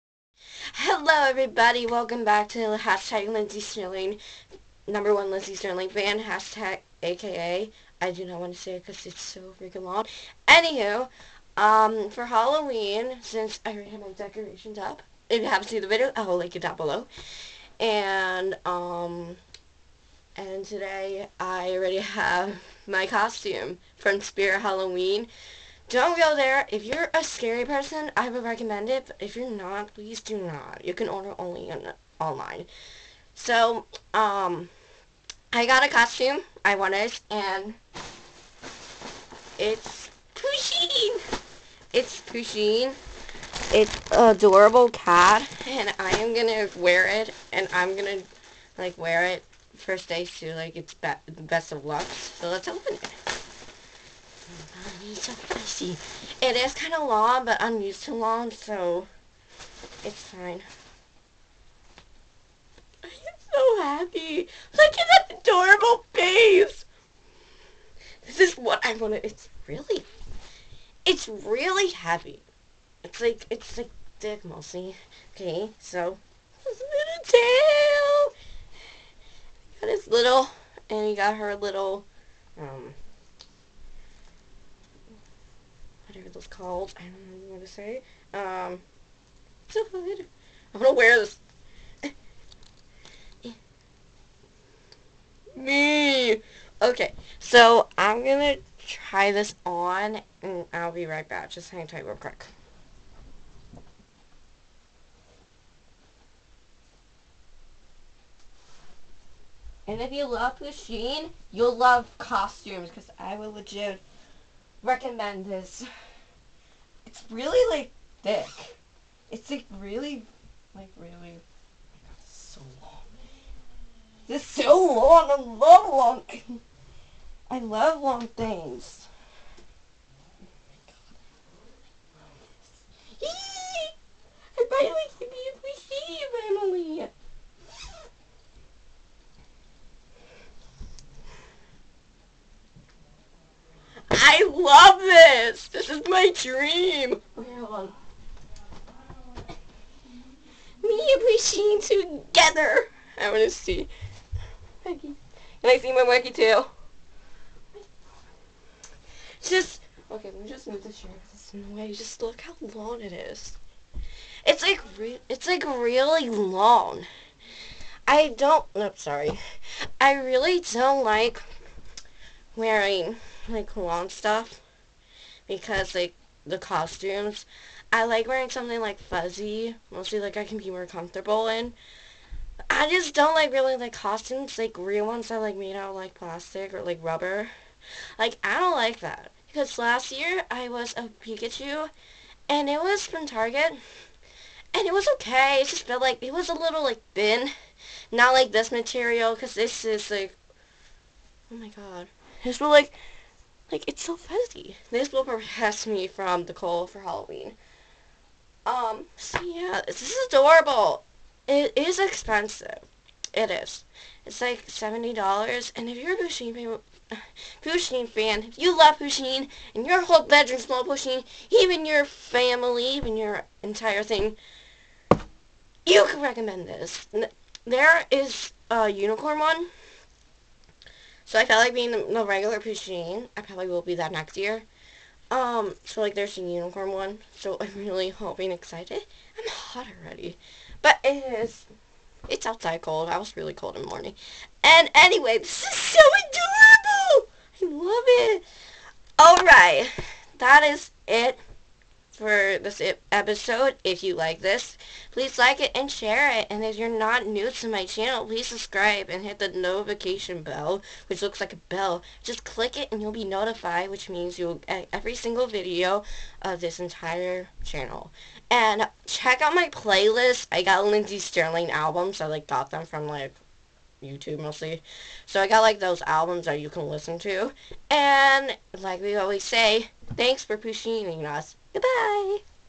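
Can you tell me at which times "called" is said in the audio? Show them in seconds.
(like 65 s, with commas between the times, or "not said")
86 s.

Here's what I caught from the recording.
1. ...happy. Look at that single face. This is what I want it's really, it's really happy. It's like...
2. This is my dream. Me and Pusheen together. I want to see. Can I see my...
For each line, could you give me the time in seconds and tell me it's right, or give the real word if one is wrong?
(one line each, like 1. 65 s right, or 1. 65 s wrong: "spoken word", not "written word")
1. 63 s wrong: "adorable", not "single"
2. 145 s right.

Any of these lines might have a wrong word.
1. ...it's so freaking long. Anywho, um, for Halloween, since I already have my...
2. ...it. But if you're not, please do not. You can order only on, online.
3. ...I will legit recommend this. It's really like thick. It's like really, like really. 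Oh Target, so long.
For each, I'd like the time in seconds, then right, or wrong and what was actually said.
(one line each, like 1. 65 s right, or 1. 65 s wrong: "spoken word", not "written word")
1. 9 s right
2. 28 s right
3. 113 s wrong: "God", not "Target".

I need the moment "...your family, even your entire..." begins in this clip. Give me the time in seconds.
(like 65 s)
221 s.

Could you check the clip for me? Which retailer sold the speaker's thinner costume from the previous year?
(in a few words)
Target.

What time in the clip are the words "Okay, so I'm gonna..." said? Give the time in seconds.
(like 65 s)
96 s.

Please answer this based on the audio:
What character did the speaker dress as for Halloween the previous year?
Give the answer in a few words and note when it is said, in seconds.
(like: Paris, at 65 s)
Pikachu, at 191 s.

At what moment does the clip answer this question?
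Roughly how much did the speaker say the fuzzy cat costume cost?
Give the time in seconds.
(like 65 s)
214 s.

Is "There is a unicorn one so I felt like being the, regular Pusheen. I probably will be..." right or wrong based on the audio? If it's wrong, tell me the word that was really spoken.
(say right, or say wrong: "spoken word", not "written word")
right.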